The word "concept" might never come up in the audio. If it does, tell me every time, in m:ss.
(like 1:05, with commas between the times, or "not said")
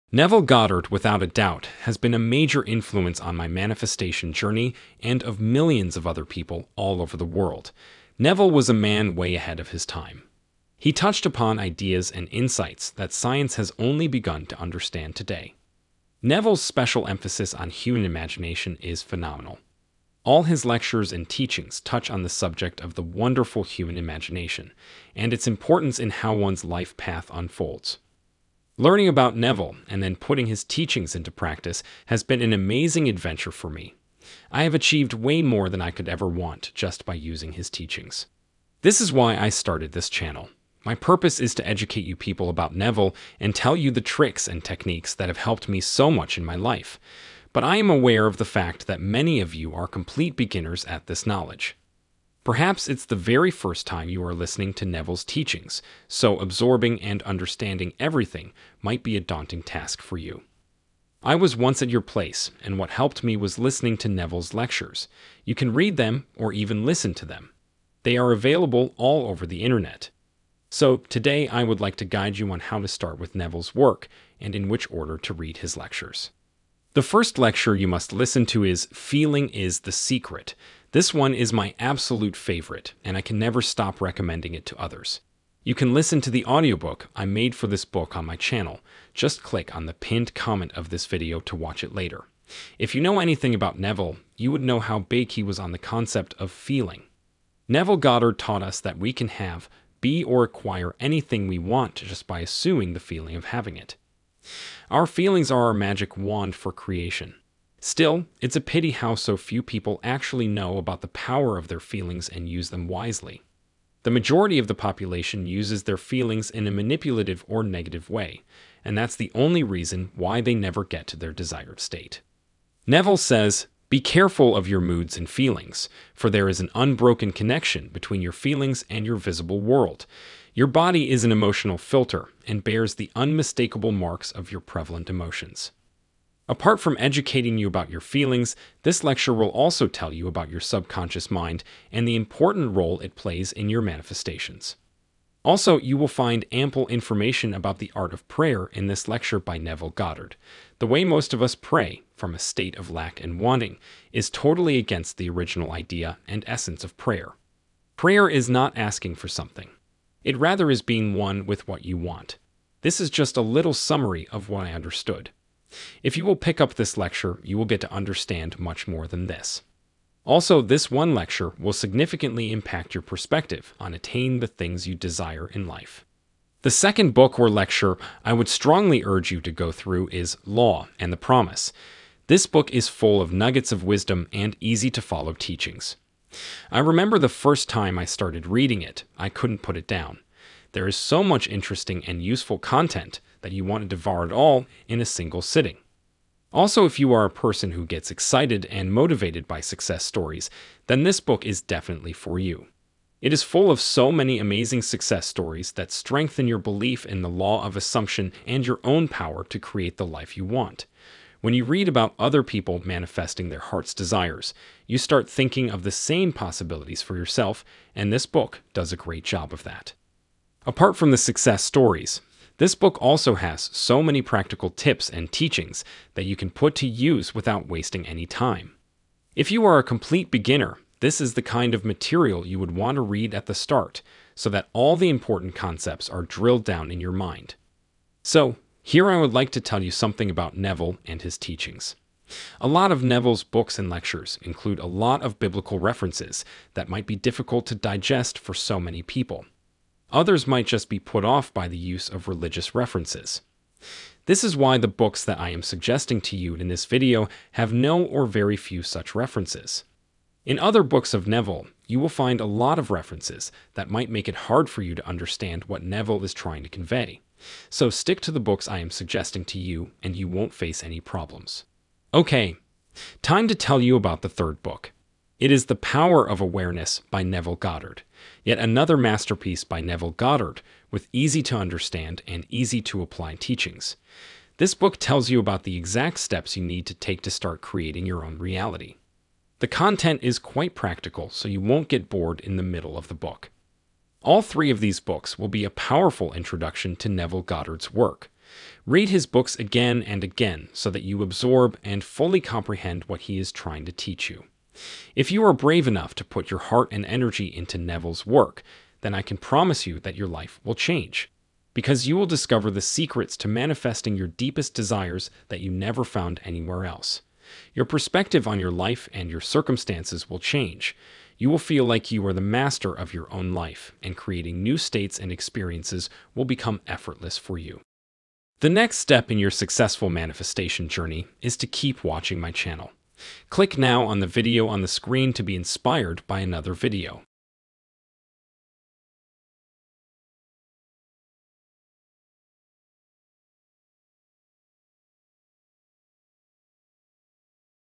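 1:35, 3:55.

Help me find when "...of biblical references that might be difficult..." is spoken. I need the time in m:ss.
4:05.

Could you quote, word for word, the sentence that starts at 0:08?
Neville was a man way ahead of his time.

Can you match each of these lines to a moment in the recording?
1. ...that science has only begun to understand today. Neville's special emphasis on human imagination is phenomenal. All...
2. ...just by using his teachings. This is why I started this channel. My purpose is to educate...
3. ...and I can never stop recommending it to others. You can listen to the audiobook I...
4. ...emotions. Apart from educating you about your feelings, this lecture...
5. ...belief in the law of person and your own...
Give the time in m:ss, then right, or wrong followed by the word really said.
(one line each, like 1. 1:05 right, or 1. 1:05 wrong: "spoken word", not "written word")
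1. 0:12 right
2. 0:36 right
3. 1:23 right
4. 2:15 right
5. 3:26 wrong: "assumption", not "person".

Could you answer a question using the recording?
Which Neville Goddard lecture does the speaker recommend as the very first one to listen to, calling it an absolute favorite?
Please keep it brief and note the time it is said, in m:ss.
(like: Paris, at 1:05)
Feeling is the Secret, at 1:18.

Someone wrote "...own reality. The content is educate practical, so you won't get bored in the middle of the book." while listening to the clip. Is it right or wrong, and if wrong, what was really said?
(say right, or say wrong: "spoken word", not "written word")
wrong: "quite", not "educate".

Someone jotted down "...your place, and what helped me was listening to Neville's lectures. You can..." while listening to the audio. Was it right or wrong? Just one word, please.
right.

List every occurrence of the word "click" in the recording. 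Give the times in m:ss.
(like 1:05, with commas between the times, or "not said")
1:29, 5:33.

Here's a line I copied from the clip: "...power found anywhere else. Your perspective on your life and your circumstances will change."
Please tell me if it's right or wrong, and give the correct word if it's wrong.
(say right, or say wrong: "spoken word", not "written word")
wrong: "never", not "power".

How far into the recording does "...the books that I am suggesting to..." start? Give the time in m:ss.
4:14.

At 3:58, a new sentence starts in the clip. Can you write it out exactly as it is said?
So, here I would like to tell you something about Neville and his teachings.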